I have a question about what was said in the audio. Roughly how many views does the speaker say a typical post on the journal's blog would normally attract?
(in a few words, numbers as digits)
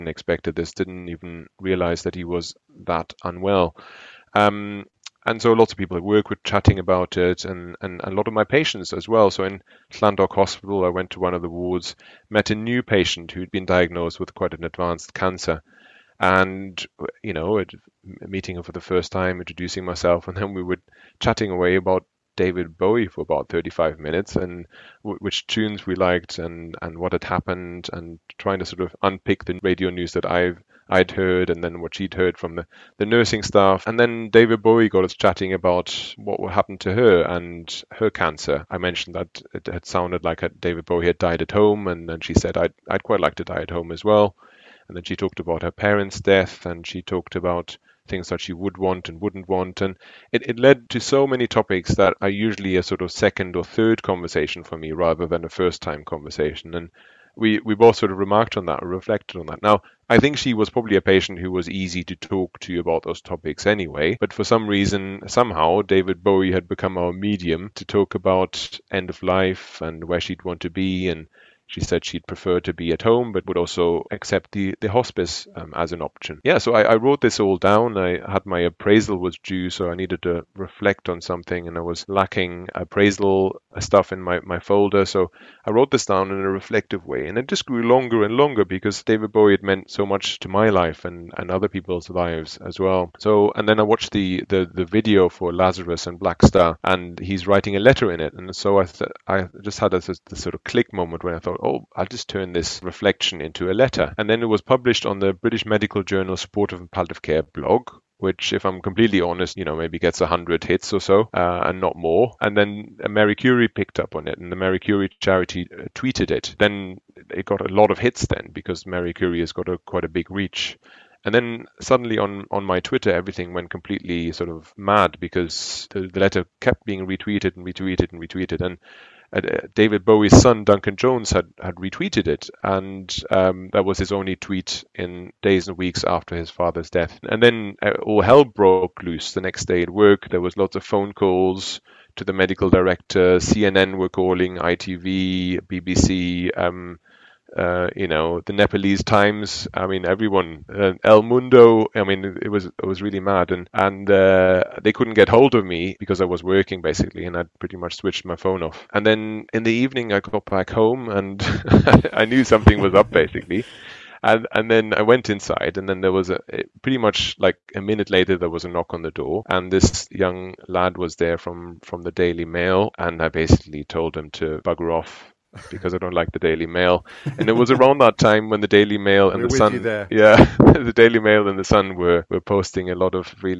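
100.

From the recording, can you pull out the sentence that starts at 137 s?
And then uh, all hell broke loose the next day at work.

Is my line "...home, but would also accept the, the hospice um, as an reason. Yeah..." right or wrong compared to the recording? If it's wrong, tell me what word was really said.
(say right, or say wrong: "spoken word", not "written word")
wrong: "option", not "reason".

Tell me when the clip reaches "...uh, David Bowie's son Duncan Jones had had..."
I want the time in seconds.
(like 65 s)
129 s.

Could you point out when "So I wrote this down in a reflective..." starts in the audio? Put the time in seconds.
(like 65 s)
85 s.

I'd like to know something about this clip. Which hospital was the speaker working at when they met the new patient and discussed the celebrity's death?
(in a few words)
Llandoch Hospital.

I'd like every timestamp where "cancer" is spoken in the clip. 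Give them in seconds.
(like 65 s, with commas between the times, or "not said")
15 s, 38 s.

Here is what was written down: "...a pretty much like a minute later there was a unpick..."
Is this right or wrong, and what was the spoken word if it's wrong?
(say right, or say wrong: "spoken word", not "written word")
wrong: "knock", not "unpick".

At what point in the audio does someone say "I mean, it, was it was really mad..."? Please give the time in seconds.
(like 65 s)
151 s.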